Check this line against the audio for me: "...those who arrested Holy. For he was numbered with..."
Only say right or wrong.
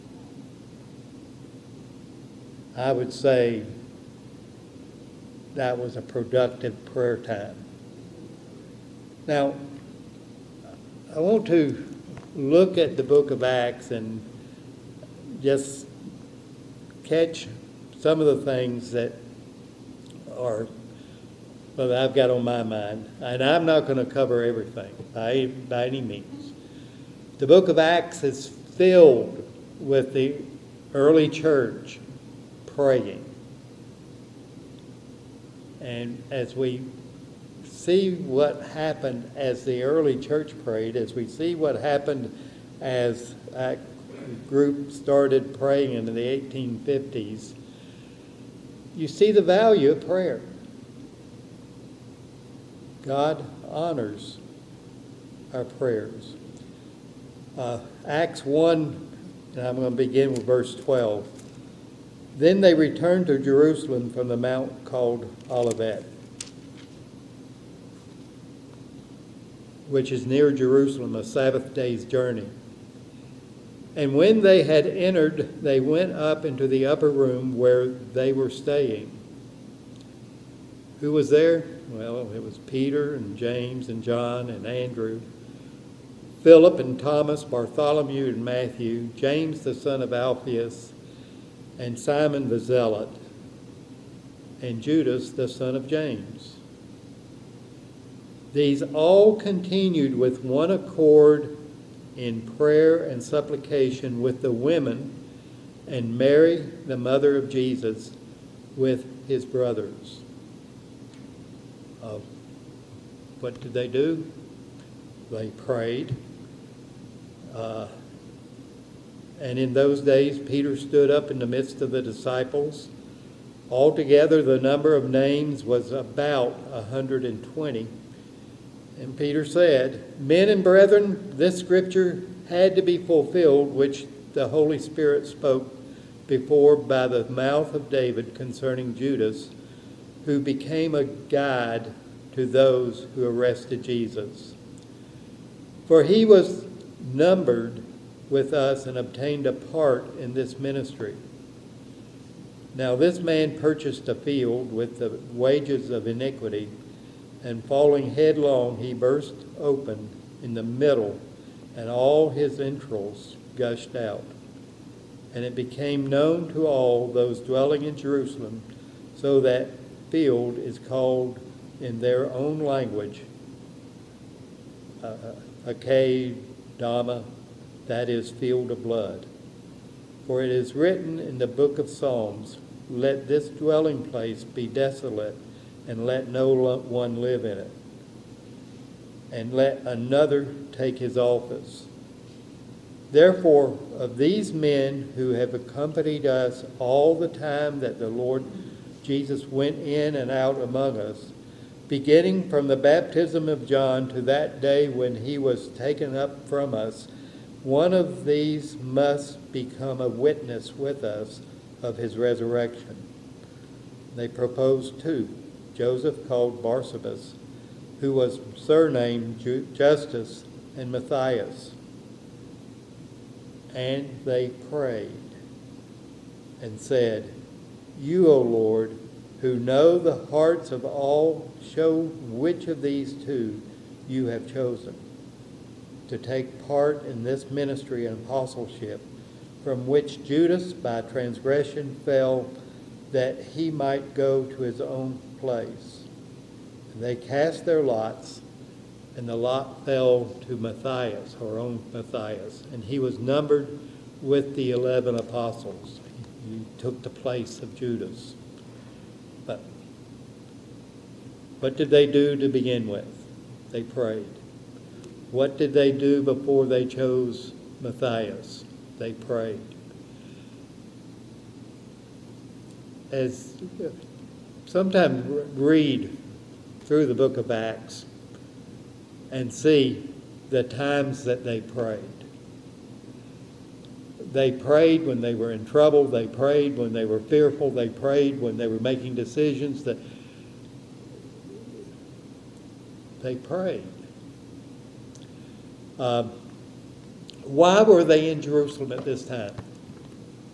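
wrong.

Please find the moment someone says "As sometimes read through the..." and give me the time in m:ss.
4:33.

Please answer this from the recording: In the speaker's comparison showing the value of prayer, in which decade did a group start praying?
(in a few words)
1850s.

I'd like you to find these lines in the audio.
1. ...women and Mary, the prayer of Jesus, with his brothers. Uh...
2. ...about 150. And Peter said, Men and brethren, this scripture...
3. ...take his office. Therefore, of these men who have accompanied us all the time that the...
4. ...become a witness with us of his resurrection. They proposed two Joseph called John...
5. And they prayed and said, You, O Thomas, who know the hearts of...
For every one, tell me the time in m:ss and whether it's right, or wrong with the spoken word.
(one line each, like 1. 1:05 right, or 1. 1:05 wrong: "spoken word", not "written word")
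1. 1:44 wrong: "mother", not "prayer"
2. 2:05 wrong: "120", not "150"
3. 3:10 right
4. 3:29 wrong: "Barsabas", not "John"
5. 3:43 wrong: "Lord", not "Thomas".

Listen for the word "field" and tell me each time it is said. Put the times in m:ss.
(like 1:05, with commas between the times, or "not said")
2:34, 2:50, 2:58.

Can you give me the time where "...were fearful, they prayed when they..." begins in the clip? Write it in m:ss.
4:47.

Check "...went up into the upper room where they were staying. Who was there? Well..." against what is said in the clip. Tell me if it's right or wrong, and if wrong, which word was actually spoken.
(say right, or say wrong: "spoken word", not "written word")
right.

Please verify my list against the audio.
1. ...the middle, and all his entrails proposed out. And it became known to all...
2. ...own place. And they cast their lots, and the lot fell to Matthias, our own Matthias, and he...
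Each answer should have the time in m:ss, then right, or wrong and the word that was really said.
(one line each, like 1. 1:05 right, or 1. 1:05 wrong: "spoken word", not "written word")
1. 2:40 wrong: "gushed", not "proposed"
2. 4:04 right.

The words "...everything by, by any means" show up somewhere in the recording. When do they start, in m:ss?
0:24.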